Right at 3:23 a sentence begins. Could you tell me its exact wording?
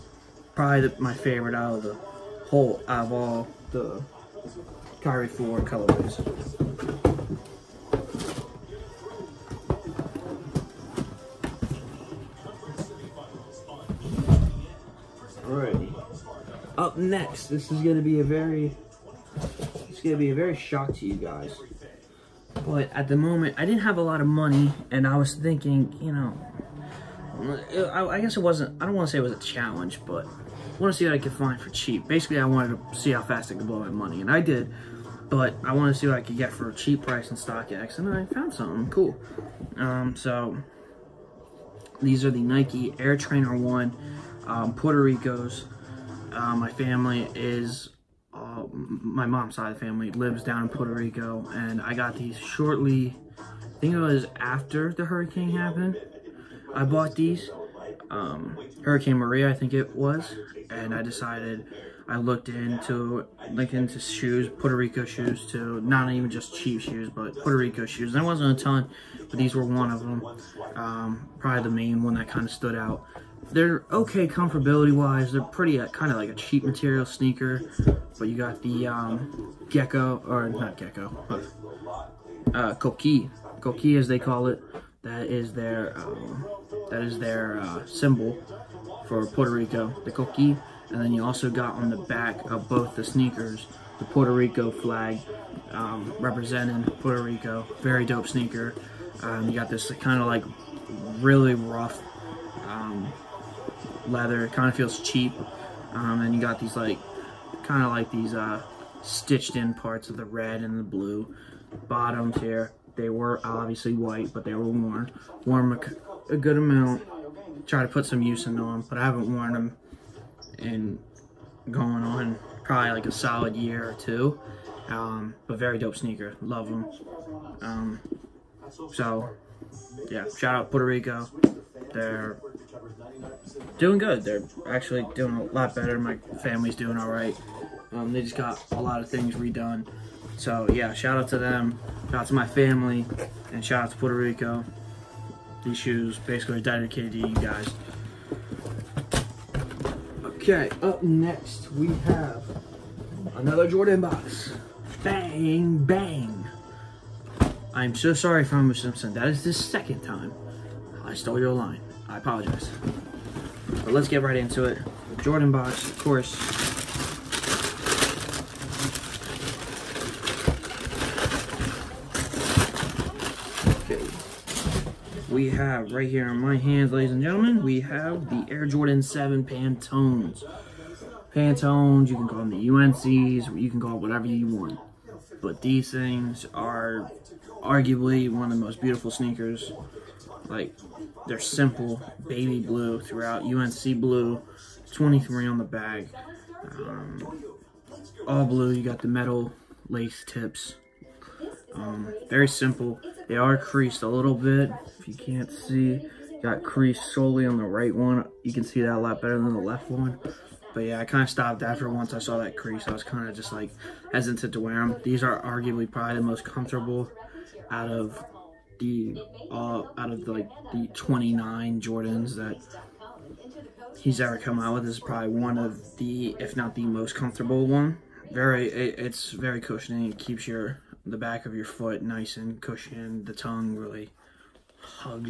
They are creased a little bit, if you can't see.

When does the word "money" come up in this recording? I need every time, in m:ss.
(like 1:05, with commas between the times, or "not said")
0:24, 0:33.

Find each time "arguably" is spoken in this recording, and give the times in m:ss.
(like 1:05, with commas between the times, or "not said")
3:07, 3:35.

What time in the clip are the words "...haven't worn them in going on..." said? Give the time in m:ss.
1:59.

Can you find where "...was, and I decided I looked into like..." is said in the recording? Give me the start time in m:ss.
0:59.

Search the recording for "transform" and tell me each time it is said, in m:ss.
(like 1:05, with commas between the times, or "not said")
not said.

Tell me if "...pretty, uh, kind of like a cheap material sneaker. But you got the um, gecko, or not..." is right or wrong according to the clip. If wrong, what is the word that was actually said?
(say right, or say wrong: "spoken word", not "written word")
right.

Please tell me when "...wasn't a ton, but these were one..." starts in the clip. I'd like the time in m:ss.
1:08.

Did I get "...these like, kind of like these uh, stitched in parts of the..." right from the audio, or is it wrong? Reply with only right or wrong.
right.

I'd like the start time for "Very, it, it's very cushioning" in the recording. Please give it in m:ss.
3:48.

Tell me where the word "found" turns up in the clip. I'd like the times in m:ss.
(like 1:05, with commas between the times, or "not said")
0:38.